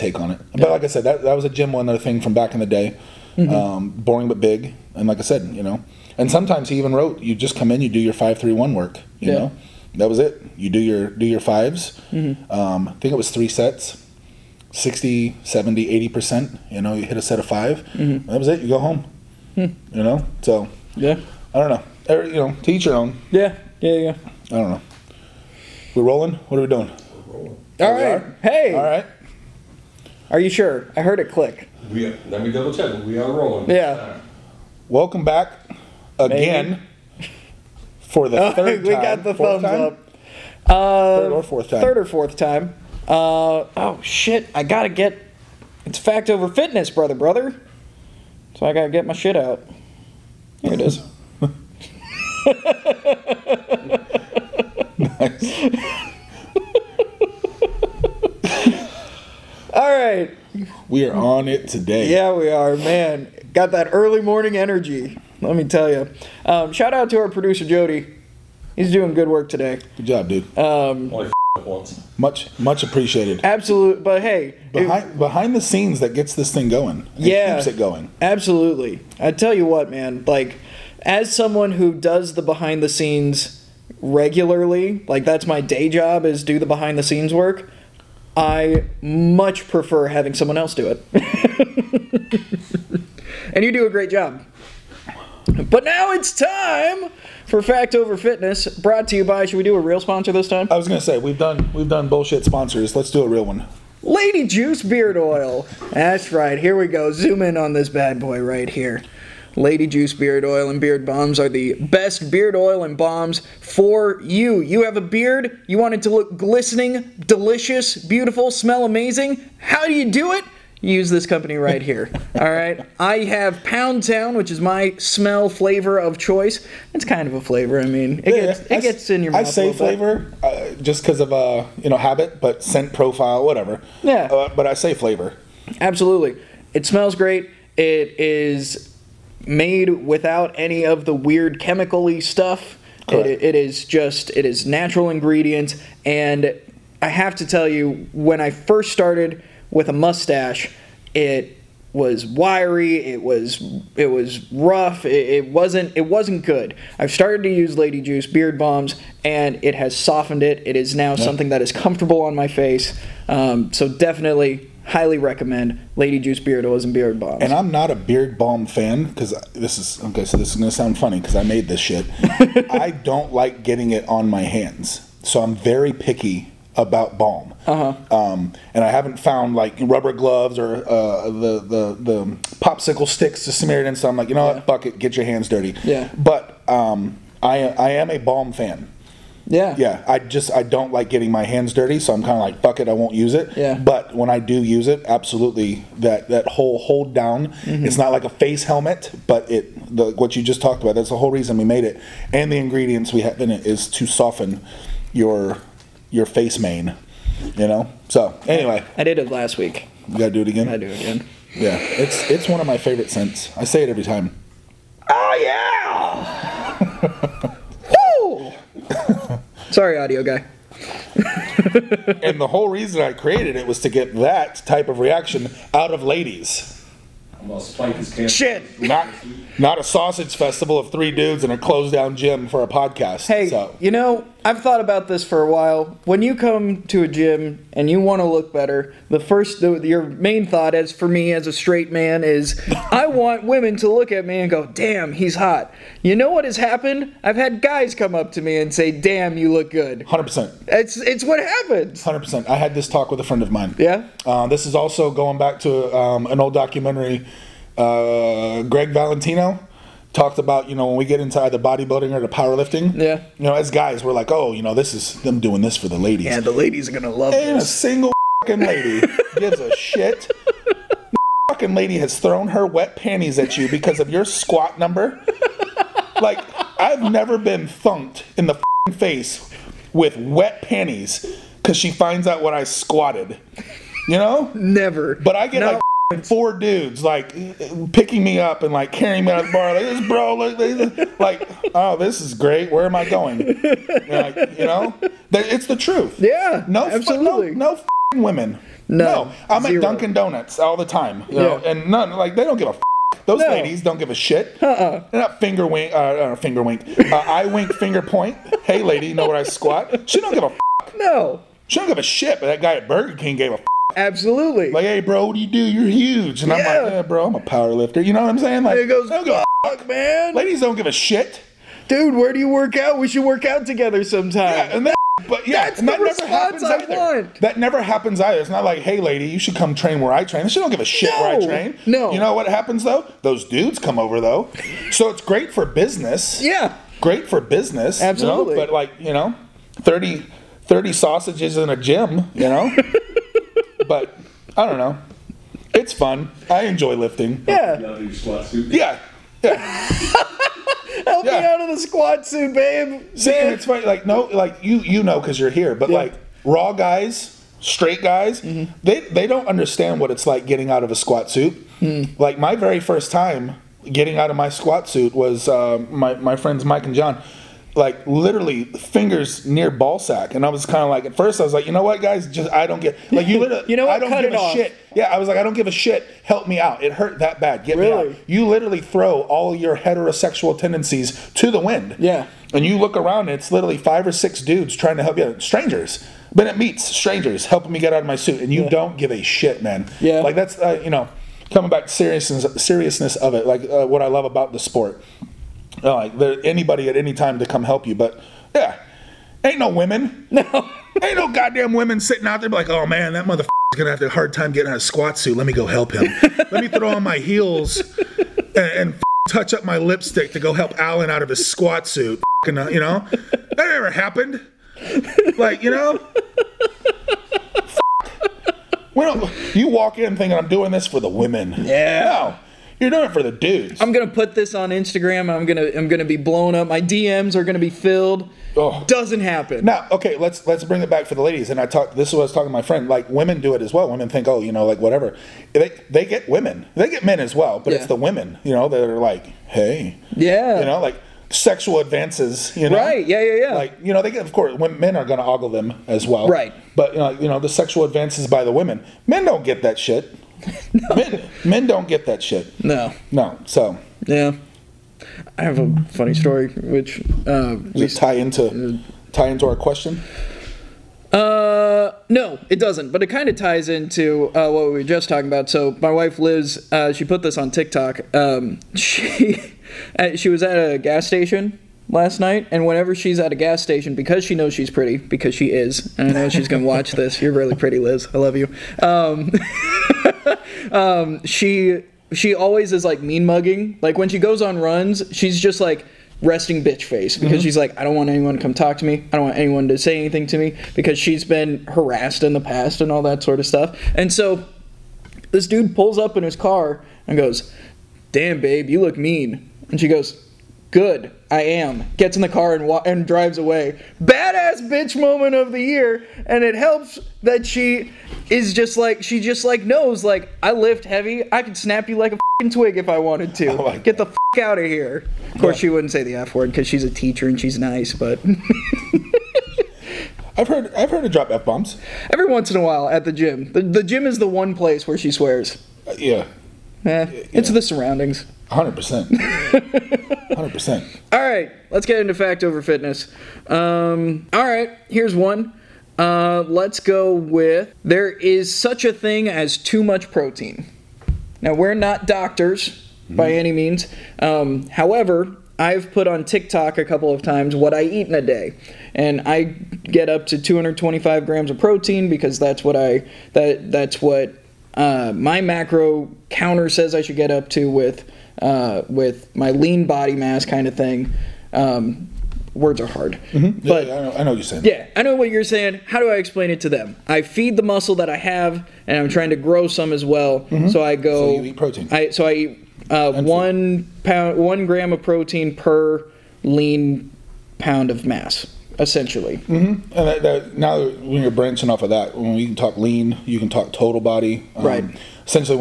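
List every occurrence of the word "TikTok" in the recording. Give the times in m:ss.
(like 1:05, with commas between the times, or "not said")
7:47, 9:06.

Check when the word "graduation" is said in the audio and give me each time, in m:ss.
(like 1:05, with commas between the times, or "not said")
not said.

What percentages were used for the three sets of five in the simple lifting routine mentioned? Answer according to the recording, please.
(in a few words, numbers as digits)
60 70 80 percent.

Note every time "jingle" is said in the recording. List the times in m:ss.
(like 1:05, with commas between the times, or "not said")
not said.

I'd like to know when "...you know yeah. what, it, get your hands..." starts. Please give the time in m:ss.
3:04.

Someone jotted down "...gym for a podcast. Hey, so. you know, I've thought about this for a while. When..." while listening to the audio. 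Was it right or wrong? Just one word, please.
right.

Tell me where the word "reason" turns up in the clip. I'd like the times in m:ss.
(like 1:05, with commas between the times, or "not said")
3:21, 3:42.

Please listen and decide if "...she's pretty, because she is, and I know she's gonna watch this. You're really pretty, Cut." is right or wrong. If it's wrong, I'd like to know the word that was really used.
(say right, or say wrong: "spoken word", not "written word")
wrong: "Liz", not "Cut".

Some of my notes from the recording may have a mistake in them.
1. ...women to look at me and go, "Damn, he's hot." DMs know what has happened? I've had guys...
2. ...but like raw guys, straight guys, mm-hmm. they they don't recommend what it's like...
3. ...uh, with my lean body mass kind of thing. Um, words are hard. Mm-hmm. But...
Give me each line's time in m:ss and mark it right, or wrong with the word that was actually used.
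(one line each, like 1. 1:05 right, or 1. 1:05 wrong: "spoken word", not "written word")
1. 4:03 wrong: "You", not "DMs"
2. 5:55 wrong: "understand", not "recommend"
3. 9:18 right.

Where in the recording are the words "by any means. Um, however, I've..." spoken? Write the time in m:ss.
9:03.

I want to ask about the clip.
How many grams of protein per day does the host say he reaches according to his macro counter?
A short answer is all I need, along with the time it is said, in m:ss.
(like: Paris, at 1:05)
225 grams, at 9:10.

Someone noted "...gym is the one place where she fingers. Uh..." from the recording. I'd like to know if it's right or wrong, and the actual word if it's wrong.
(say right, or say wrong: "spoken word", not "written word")
wrong: "swears", not "fingers".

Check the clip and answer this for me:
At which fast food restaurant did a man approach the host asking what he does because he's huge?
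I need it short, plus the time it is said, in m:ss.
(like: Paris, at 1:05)
Burger King, at 5:12.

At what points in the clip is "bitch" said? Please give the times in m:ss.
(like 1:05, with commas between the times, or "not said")
8:06, 8:24.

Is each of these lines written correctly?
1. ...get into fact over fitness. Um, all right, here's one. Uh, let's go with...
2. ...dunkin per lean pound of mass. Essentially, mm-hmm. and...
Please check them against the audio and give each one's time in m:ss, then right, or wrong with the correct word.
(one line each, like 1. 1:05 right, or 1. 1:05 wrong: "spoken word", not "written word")
1. 8:51 right
2. 9:35 wrong: "protein", not "dunkin".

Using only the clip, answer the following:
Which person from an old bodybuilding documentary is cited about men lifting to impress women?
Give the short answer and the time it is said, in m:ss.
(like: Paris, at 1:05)
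Greg Valentino, at 4:18.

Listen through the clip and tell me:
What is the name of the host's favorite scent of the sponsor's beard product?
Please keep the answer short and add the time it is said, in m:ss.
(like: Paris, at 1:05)
Pound Town, at 2:03.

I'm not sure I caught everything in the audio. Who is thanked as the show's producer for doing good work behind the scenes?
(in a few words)
Jody.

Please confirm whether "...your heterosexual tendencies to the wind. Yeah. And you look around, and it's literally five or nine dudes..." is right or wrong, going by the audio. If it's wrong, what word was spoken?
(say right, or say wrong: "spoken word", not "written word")
wrong: "six", not "nine".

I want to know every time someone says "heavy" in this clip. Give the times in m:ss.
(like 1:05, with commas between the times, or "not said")
8:30.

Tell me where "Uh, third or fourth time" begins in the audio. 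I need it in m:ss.
0:40.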